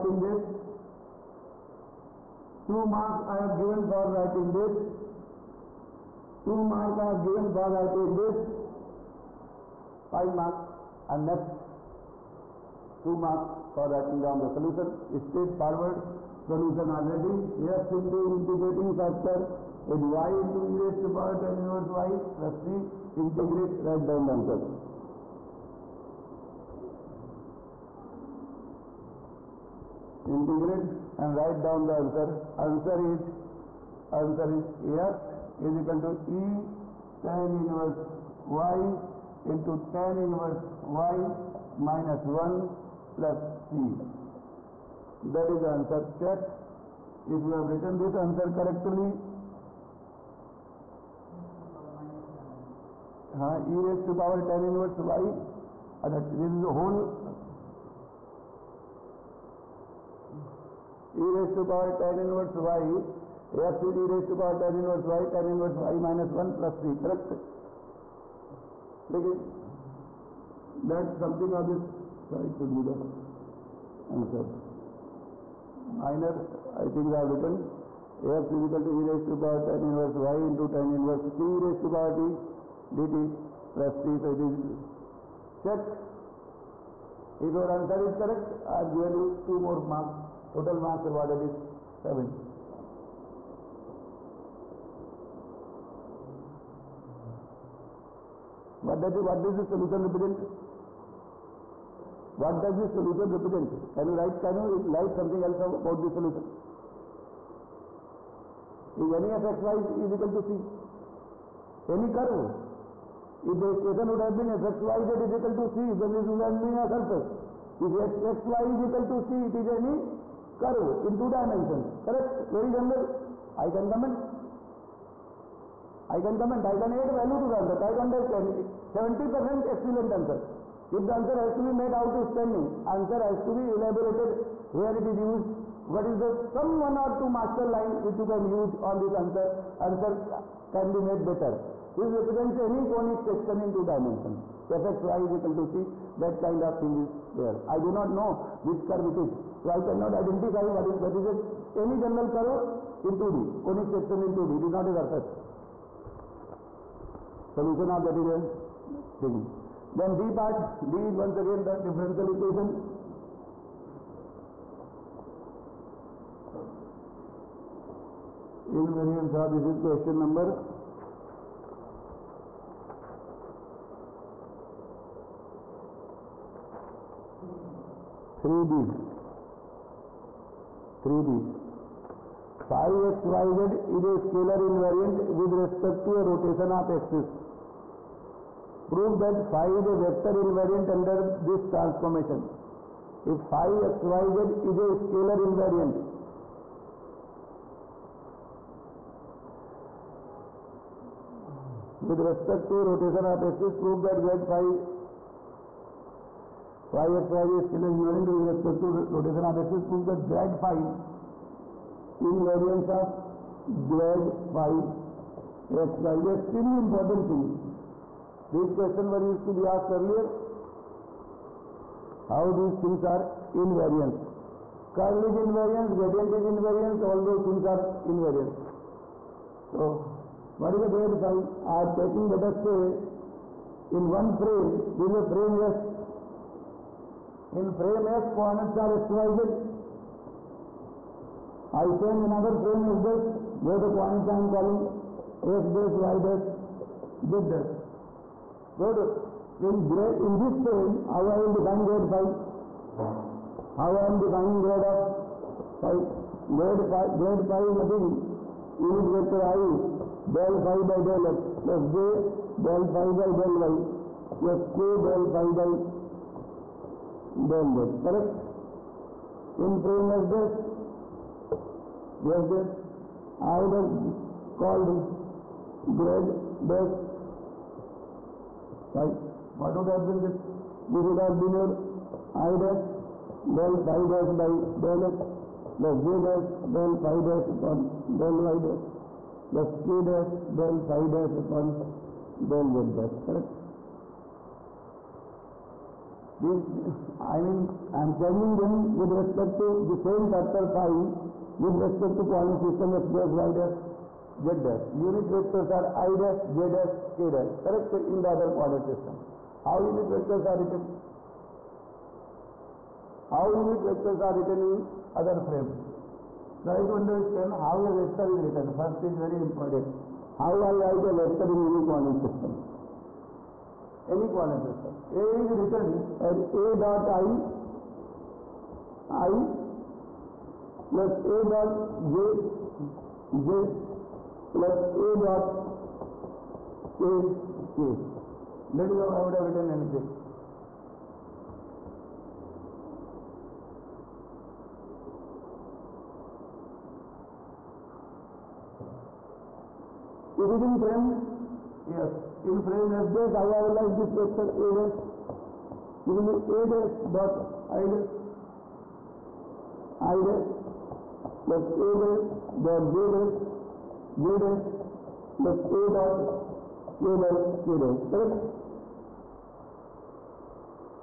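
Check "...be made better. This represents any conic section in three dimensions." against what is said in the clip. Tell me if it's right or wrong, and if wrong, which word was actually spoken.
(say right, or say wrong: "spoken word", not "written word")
wrong: "two", not "three".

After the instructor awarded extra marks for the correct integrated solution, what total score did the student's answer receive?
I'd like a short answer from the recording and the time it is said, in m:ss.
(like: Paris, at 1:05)
7, at 1:32.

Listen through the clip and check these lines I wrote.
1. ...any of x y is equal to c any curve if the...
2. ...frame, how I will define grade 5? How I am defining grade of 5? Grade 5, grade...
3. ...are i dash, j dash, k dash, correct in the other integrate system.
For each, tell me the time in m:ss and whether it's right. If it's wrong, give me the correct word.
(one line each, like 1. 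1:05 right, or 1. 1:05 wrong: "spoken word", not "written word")
1. 1:49 right
2. 4:10 right
3. 5:05 wrong: "coordinate", not "integrate".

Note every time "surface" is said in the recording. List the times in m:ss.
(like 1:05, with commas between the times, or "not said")
1:56, 2:34.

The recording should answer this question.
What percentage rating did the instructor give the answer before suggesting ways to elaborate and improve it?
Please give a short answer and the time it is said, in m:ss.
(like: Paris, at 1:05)
70%, at 2:08.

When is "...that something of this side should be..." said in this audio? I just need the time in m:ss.
1:10.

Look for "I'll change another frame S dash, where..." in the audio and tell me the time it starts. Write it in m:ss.
4:01.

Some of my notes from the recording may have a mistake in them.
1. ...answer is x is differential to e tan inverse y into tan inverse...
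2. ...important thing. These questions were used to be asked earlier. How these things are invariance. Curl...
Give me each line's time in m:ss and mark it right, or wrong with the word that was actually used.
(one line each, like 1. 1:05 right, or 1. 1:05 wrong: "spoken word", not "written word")
1. 0:34 wrong: "equal", not "differential"
2. 3:36 right.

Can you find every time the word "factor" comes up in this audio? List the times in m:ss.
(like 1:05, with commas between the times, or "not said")
0:18, 5:00.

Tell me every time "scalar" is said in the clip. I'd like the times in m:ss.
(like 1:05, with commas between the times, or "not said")
3:15, 3:27.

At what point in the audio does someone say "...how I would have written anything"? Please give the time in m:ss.
5:39.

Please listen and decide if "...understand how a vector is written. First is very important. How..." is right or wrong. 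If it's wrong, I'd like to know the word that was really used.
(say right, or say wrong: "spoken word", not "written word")
right.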